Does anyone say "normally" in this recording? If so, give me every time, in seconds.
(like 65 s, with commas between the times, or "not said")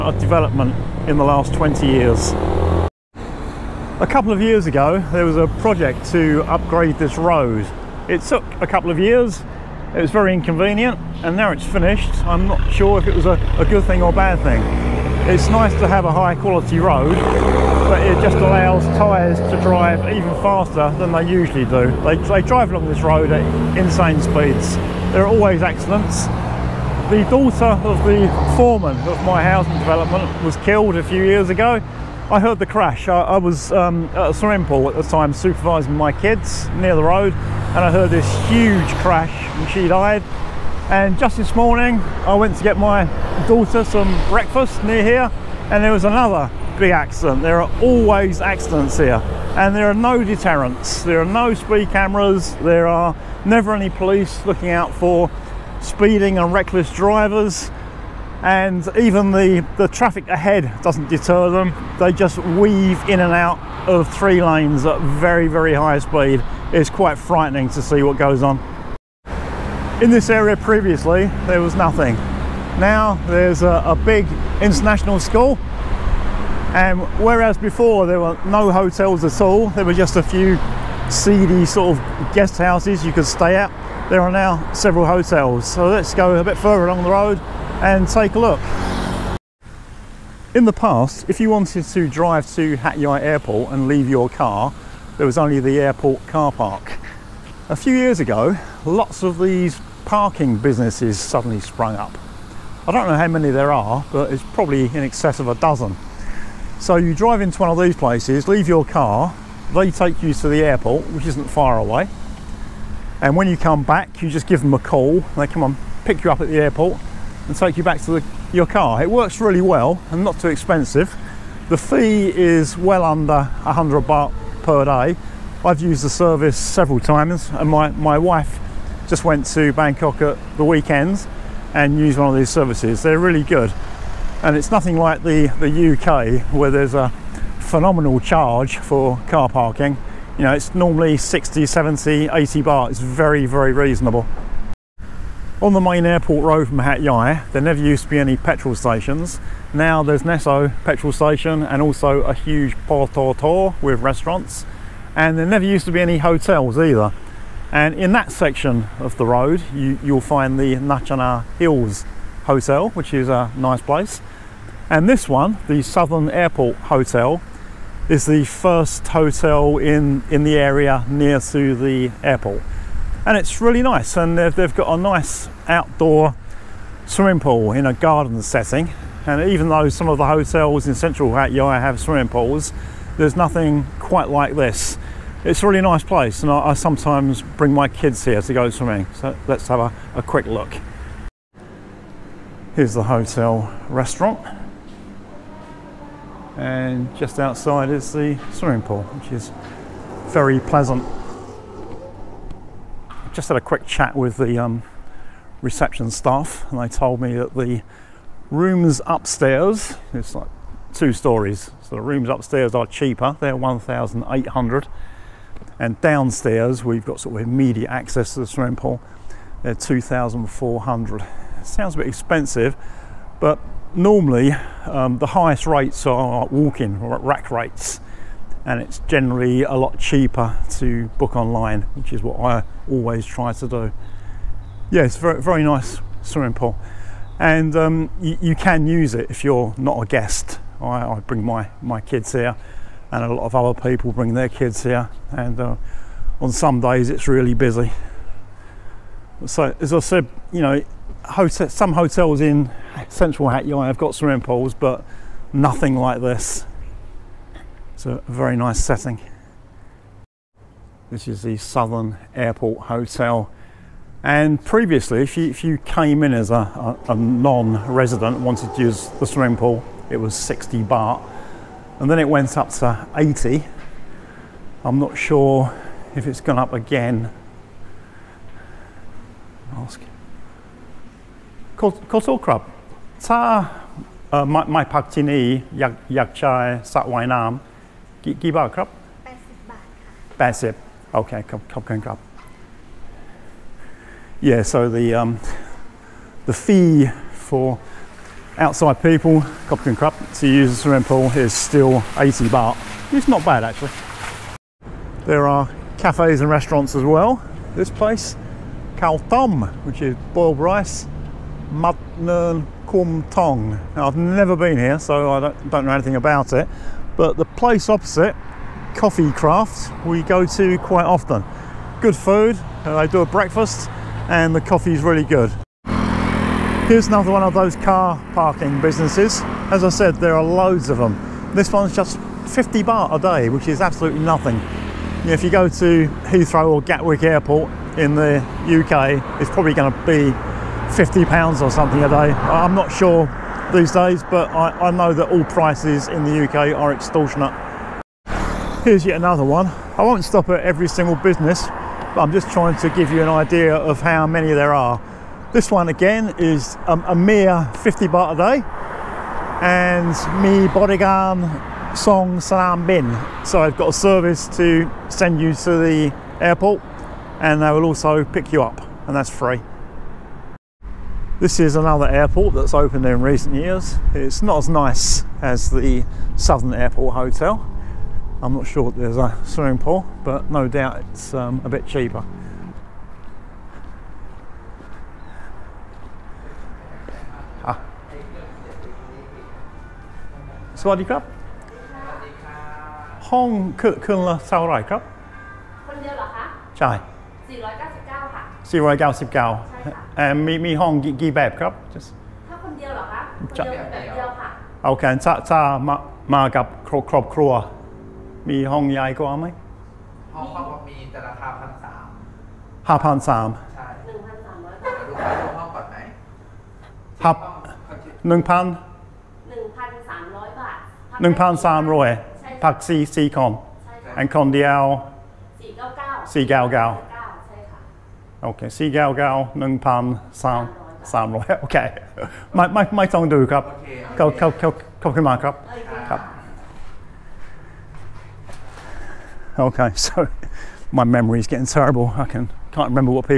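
140 s, 223 s.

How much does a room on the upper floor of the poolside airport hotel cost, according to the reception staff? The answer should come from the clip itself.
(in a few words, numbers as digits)
1,800.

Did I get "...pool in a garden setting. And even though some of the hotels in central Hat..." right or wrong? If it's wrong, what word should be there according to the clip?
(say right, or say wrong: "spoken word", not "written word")
right.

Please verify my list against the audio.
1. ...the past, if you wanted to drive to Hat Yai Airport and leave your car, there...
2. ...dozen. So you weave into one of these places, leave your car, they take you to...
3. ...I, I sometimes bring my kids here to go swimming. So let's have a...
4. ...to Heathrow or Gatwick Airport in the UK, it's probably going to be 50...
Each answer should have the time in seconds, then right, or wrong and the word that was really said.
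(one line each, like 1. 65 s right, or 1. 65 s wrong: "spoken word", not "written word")
1. 90 s right
2. 105 s wrong: "drive", not "weave"
3. 186 s right
4. 335 s right.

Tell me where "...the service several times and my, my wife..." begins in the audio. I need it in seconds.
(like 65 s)
126 s.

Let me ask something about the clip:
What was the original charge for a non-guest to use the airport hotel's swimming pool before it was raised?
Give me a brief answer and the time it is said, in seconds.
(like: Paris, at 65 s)
60 baht, at 270 s.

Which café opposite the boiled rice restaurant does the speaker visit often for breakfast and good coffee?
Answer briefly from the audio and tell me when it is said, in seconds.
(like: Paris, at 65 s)
Coffee Craft, at 318 s.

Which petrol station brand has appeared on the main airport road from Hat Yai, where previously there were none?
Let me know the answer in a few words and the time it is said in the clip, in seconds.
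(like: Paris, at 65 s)
Nesso, at 150 s.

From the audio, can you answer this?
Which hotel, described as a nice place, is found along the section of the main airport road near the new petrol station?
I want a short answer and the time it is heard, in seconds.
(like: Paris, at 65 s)
Nutchana Hills Hotel, at 160 s.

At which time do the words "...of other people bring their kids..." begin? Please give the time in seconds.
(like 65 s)
243 s.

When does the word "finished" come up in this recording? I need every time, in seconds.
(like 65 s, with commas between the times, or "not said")
11 s.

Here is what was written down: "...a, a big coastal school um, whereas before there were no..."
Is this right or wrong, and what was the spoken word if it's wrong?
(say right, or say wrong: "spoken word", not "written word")
wrong: "international", not "coastal".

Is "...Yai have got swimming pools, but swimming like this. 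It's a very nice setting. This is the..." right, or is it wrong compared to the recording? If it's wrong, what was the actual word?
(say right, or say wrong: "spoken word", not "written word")
wrong: "nothing", not "swimming".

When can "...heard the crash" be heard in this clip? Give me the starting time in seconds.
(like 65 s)
32 s.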